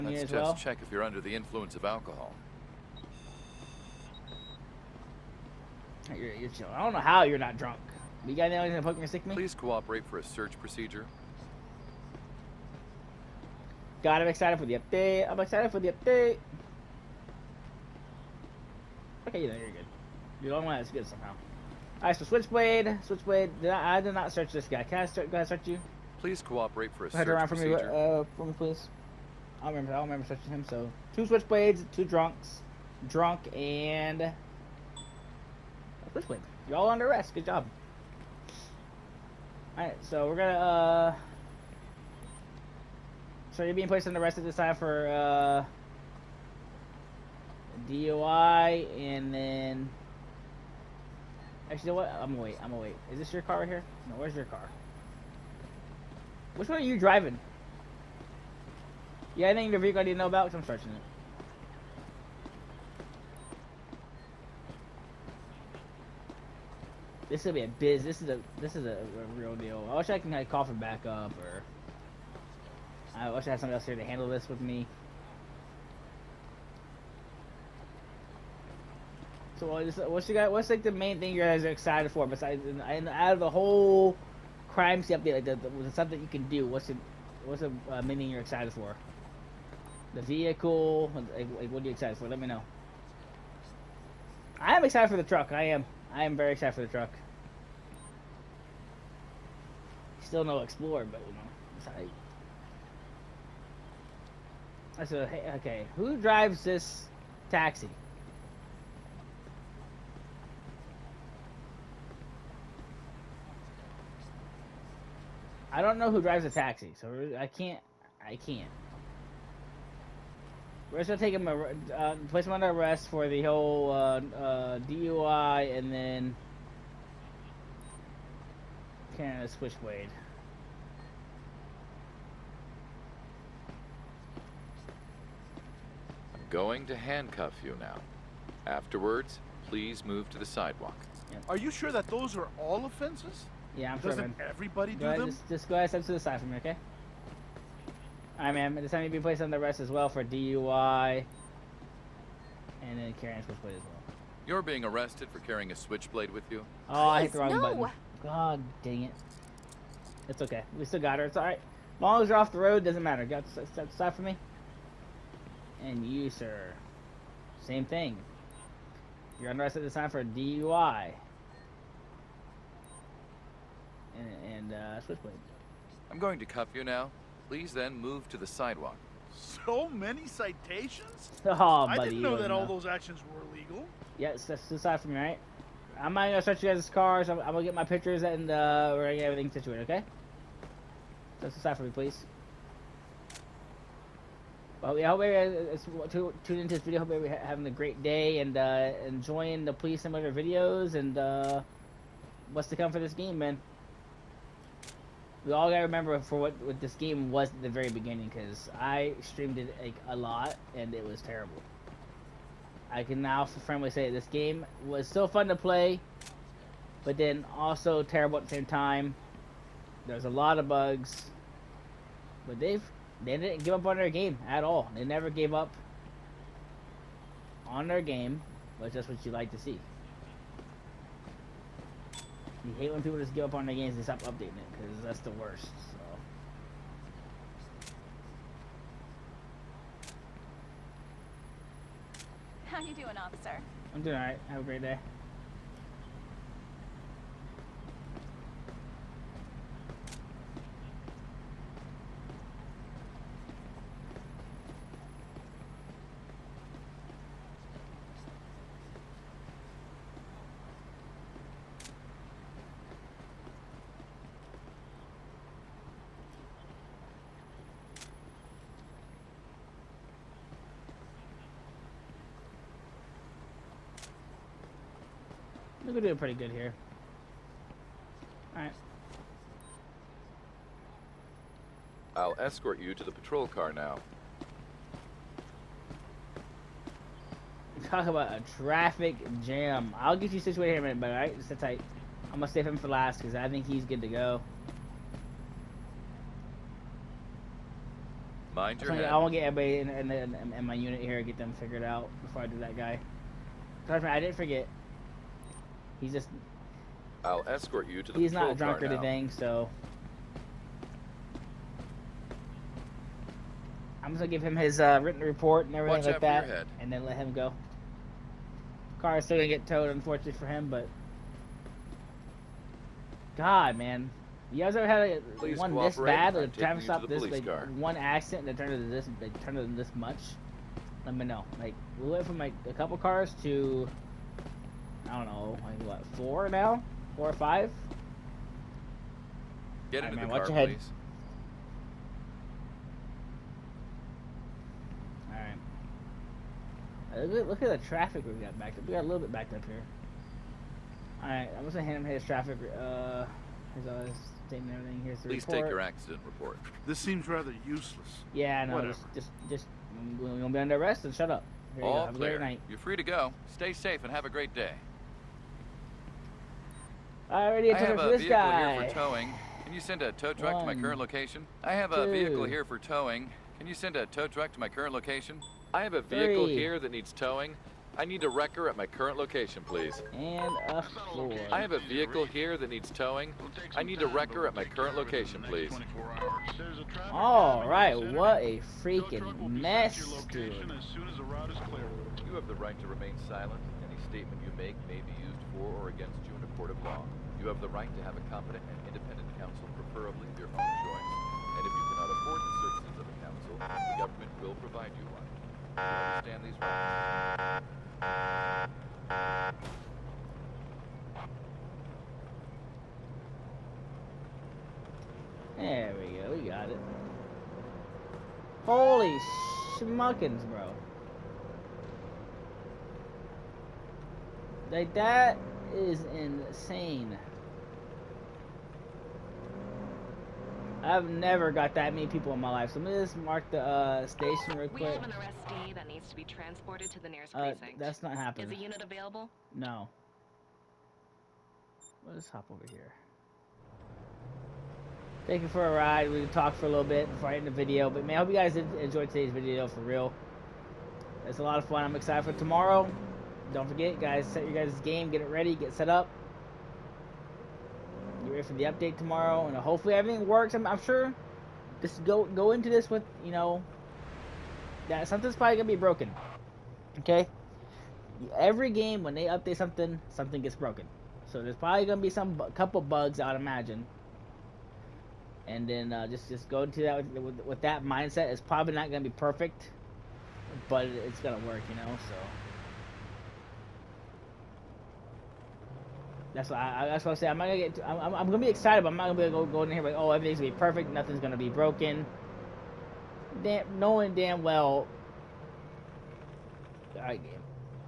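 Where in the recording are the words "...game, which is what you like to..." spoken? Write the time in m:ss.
3:48.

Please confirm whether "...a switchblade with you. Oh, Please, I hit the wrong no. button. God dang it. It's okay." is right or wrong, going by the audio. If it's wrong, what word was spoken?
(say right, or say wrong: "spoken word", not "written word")
right.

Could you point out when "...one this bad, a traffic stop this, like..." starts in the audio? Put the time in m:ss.
5:25.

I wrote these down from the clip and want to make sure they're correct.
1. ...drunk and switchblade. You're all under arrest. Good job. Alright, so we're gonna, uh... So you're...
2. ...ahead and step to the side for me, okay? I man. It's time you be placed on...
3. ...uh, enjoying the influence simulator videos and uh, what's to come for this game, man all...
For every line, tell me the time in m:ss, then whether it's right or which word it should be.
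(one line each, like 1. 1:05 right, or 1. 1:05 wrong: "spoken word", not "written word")
1. 0:33 right
2. 2:25 right
3. 3:18 wrong: "police", not "influence".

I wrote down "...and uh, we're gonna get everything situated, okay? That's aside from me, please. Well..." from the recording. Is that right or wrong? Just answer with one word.
right.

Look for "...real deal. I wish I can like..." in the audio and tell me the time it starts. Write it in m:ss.
1:09.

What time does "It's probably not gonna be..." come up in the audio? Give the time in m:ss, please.
7:58.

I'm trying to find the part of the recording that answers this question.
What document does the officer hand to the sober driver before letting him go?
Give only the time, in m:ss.
5:55.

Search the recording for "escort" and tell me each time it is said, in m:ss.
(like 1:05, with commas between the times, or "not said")
4:42, 5:07.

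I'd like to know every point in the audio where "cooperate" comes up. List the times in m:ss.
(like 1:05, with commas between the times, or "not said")
0:09, 0:26.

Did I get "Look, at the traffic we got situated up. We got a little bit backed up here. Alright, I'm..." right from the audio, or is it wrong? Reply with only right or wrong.
wrong.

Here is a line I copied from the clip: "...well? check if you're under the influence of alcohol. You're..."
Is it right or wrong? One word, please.
right.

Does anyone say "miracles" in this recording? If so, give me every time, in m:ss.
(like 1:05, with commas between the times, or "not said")
not said.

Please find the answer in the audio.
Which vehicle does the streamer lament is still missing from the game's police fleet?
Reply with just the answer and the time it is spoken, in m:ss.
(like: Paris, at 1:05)
Explorer, at 1:40.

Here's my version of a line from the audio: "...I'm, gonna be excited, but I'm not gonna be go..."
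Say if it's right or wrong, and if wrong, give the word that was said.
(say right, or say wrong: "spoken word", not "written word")
right.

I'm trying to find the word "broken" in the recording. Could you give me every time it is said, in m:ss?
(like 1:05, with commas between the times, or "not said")
7:45, 7:50, 8:11.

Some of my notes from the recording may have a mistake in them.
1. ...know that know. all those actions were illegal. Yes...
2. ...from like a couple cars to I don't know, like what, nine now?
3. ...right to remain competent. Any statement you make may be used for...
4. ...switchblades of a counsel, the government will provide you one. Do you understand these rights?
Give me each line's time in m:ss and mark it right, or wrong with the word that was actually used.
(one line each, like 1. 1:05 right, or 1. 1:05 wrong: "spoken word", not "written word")
1. 3:02 right
2. 5:32 wrong: "four", not "nine"
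3. 6:32 wrong: "silent", not "competent"
4. 6:42 wrong: "services", not "switchblades".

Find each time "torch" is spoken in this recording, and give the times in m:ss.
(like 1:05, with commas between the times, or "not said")
not said.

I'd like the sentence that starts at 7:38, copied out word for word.
Get ready for the update tomorrow, and hopefully everything works.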